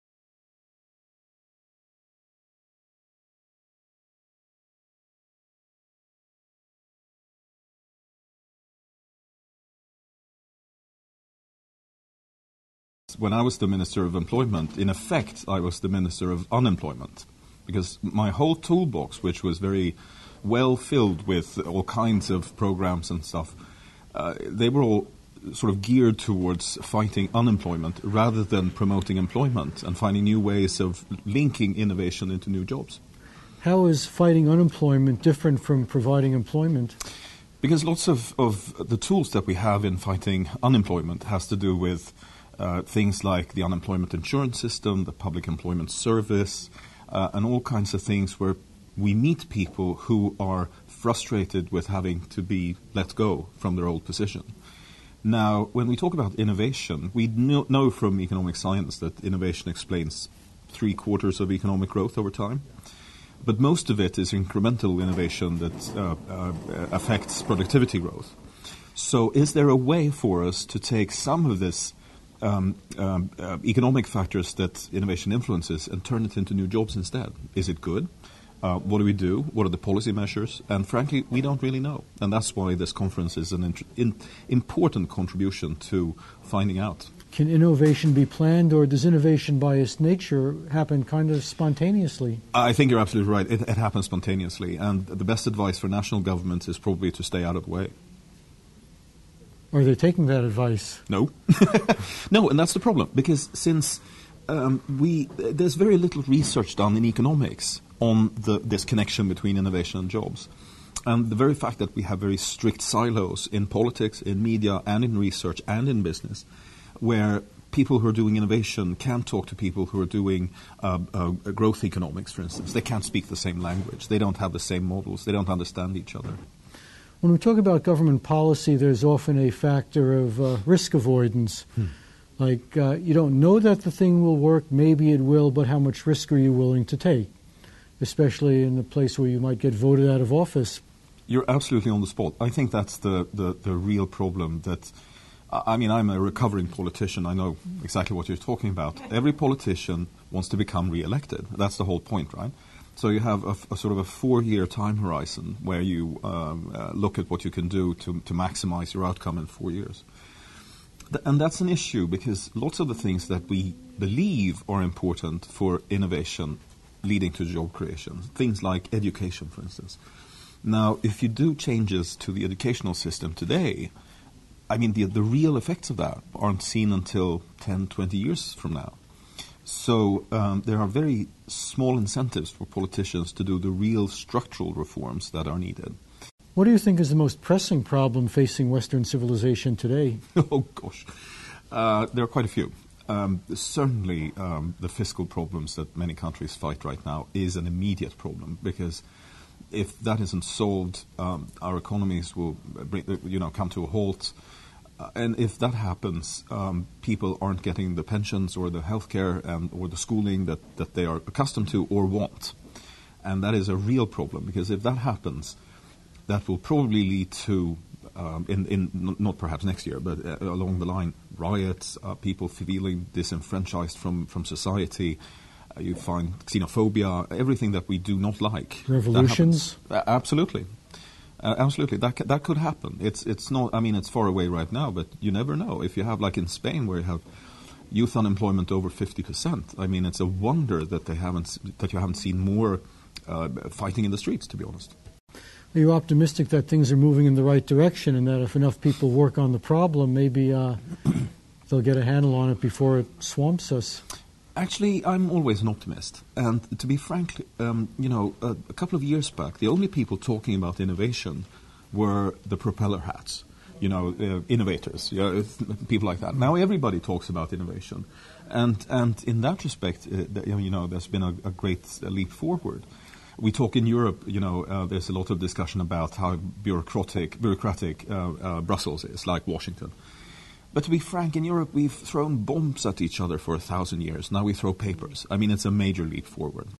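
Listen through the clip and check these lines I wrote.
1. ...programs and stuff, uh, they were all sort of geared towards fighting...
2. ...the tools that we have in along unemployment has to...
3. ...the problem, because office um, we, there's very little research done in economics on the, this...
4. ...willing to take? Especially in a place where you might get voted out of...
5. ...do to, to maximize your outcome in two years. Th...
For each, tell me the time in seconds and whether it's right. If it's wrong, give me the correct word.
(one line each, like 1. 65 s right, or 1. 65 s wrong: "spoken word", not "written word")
1. 22 s right
2. 38 s wrong: "fighting", not "along"
3. 102 s wrong: "since", not "office"
4. 136 s right
5. 157 s wrong: "four", not "two".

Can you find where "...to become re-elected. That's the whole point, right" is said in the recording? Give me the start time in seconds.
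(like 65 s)
150 s.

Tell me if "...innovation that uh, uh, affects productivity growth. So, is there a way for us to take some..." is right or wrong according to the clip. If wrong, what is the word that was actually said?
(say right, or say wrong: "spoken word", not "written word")
right.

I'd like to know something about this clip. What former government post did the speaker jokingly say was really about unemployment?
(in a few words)
Minister of Employment.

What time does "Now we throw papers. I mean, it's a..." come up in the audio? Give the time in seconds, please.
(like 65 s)
284 s.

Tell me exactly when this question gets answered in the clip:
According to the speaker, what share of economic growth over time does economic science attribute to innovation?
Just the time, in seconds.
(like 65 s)
60 s.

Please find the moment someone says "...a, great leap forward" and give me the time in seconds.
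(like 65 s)
271 s.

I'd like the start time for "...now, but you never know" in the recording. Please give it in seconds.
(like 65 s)
234 s.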